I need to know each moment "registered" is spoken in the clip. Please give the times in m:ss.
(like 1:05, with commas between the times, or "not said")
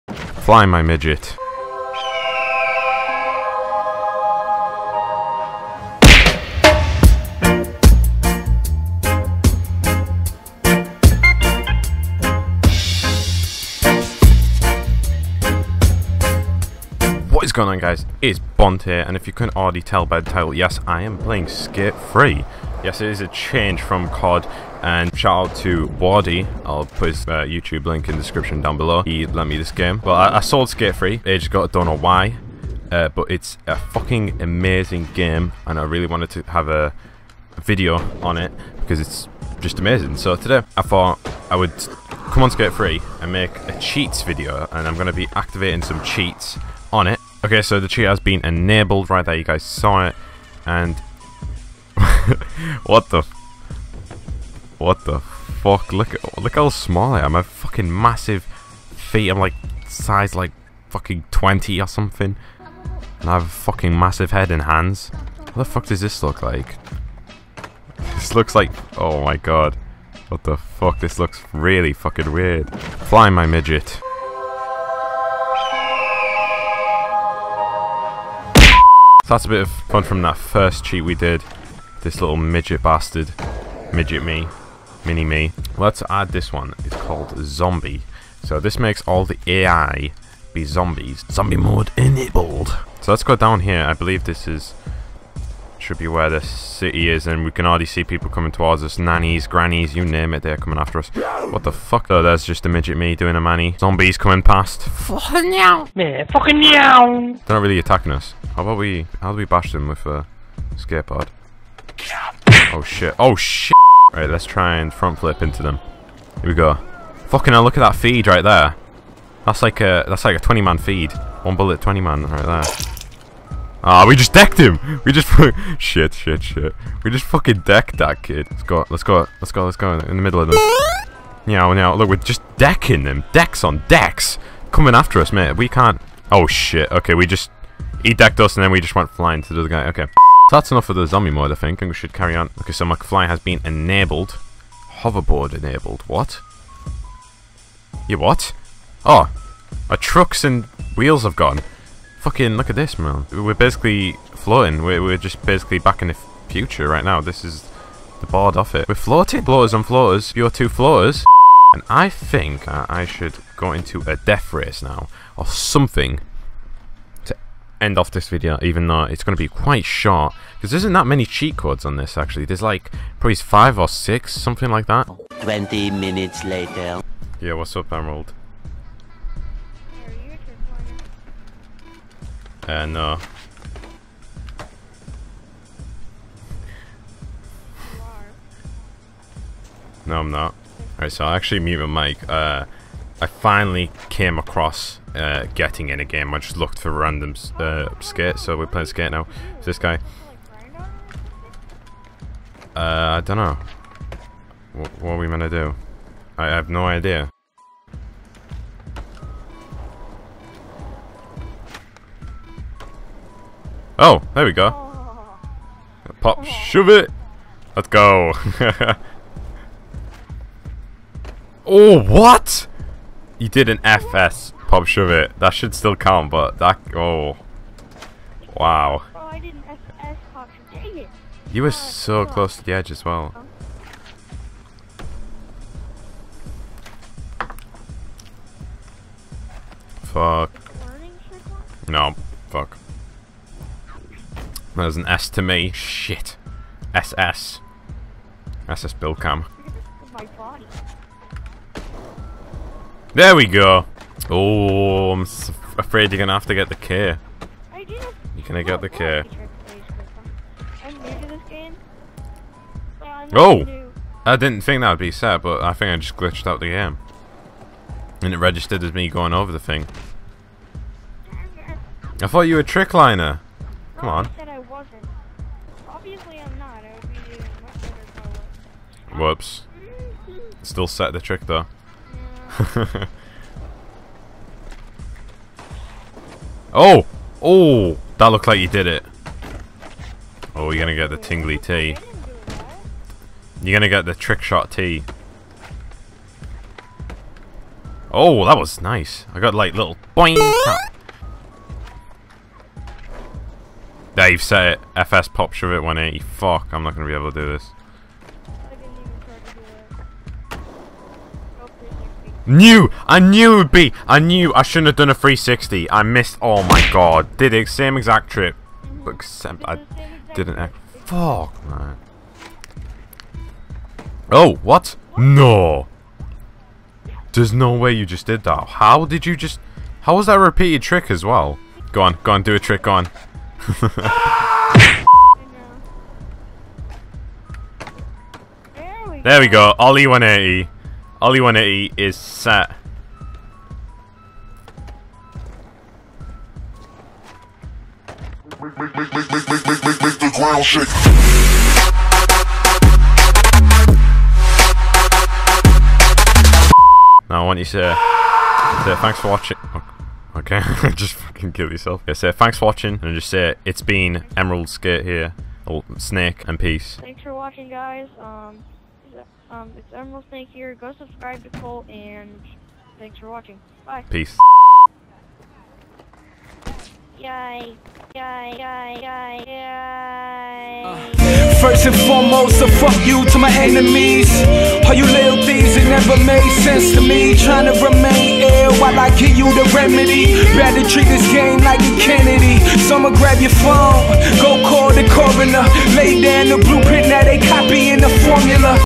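4:28.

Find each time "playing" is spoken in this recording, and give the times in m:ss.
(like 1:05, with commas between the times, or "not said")
0:21, 3:18.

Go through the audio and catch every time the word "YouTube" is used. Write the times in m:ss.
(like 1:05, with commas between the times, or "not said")
0:27.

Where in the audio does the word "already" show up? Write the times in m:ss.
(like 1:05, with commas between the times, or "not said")
0:19, 1:37.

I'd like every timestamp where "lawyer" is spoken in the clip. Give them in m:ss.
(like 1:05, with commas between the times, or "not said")
not said.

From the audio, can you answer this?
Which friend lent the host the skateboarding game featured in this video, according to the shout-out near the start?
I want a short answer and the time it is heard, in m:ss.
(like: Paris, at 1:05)
Wardy, at 0:25.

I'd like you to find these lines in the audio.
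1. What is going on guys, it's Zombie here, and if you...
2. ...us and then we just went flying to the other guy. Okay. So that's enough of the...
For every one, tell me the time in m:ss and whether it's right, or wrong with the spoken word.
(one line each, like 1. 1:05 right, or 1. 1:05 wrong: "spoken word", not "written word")
1. 0:17 wrong: "Bond", not "Zombie"
2. 2:18 right.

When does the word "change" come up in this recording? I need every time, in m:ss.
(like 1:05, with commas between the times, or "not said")
0:23.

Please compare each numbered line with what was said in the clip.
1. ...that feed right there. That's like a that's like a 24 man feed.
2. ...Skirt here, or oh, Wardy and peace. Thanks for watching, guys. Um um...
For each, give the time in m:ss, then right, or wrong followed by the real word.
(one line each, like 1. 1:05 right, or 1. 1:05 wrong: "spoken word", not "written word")
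1. 1:57 wrong: "20", not "24"
2. 6:04 wrong: "Snake", not "Wardy".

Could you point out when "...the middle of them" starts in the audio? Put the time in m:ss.
2:10.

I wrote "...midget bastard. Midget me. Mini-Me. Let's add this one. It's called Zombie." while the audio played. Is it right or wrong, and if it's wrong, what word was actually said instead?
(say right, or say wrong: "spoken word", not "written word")
right.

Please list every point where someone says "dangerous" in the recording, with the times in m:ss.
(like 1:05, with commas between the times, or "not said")
not said.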